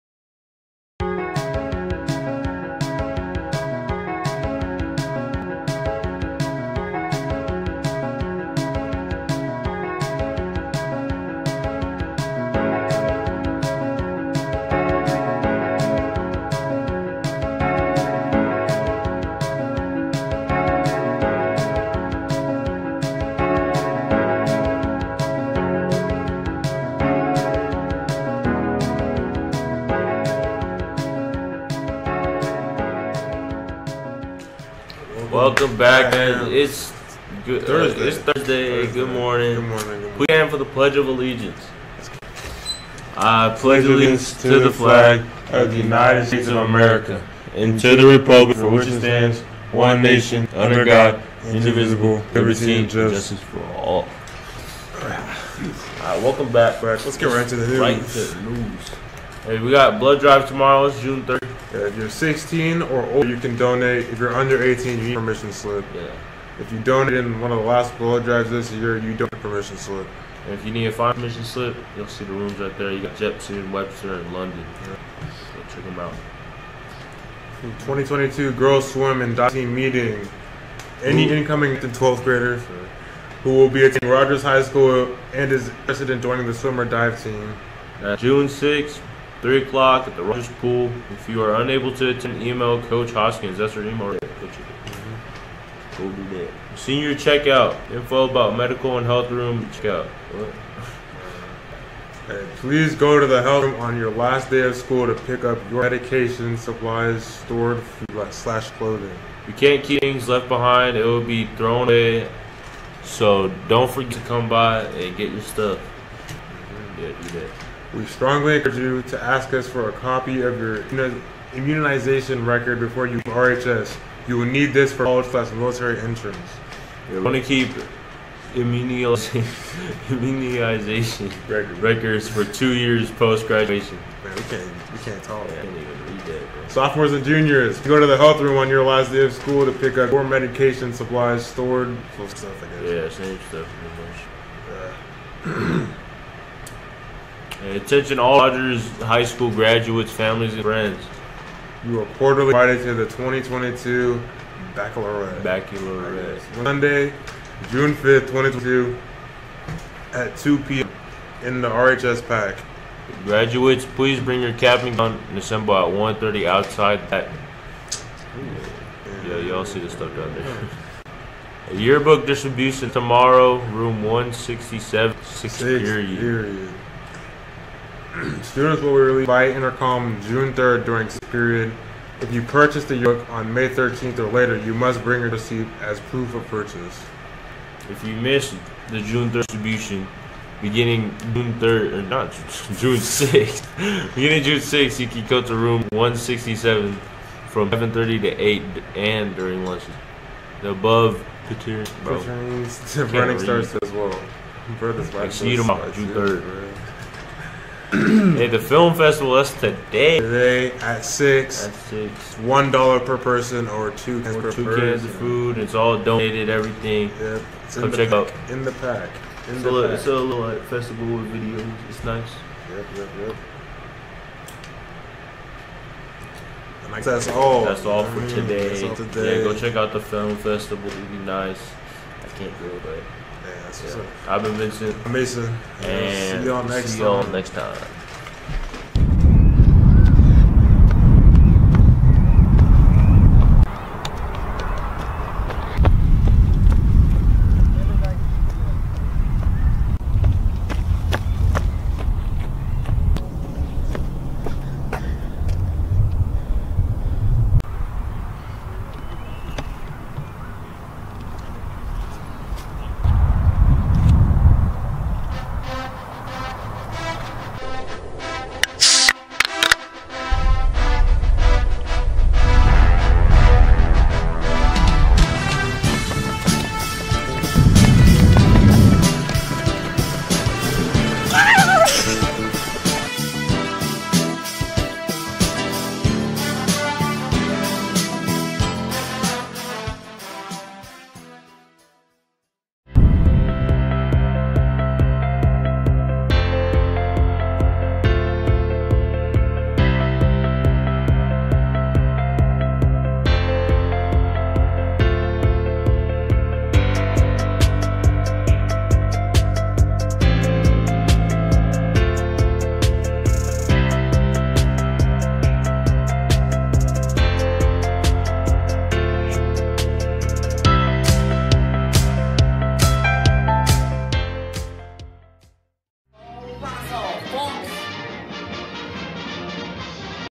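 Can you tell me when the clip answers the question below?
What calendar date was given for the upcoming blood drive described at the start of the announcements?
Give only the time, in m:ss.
1:00.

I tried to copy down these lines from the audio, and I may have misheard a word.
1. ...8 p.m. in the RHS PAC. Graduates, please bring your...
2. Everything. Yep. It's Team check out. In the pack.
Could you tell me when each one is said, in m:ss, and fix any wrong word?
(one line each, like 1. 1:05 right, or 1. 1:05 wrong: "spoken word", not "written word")
1. 2:40 wrong: "2", not "8"
2. 3:36 wrong: "Come", not "Team".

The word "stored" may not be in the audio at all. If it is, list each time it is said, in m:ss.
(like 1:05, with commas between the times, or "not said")
1:47, 2:21.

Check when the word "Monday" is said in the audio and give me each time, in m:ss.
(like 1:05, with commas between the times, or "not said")
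2:36.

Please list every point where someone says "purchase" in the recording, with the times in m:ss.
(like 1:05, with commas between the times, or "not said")
3:02, 3:06.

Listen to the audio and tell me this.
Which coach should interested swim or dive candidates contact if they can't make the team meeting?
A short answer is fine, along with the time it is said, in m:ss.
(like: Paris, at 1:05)
Coach Hoskins, at 1:32.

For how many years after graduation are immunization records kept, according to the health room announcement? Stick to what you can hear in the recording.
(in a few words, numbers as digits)
2.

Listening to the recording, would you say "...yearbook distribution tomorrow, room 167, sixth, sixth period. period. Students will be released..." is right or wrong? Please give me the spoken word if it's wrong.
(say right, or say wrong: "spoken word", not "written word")
right.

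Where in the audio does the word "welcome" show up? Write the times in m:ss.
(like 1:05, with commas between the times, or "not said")
0:35, 0:56.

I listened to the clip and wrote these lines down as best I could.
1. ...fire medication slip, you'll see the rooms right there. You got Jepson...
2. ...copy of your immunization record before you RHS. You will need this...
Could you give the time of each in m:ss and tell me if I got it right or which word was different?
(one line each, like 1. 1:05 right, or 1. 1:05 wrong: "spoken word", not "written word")
1. 1:10 wrong: "permission", not "medication"
2. 1:59 right.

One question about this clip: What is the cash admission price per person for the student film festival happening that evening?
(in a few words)
$1.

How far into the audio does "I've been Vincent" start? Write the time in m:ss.
3:54.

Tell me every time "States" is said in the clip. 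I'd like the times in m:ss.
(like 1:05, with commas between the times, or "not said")
0:46.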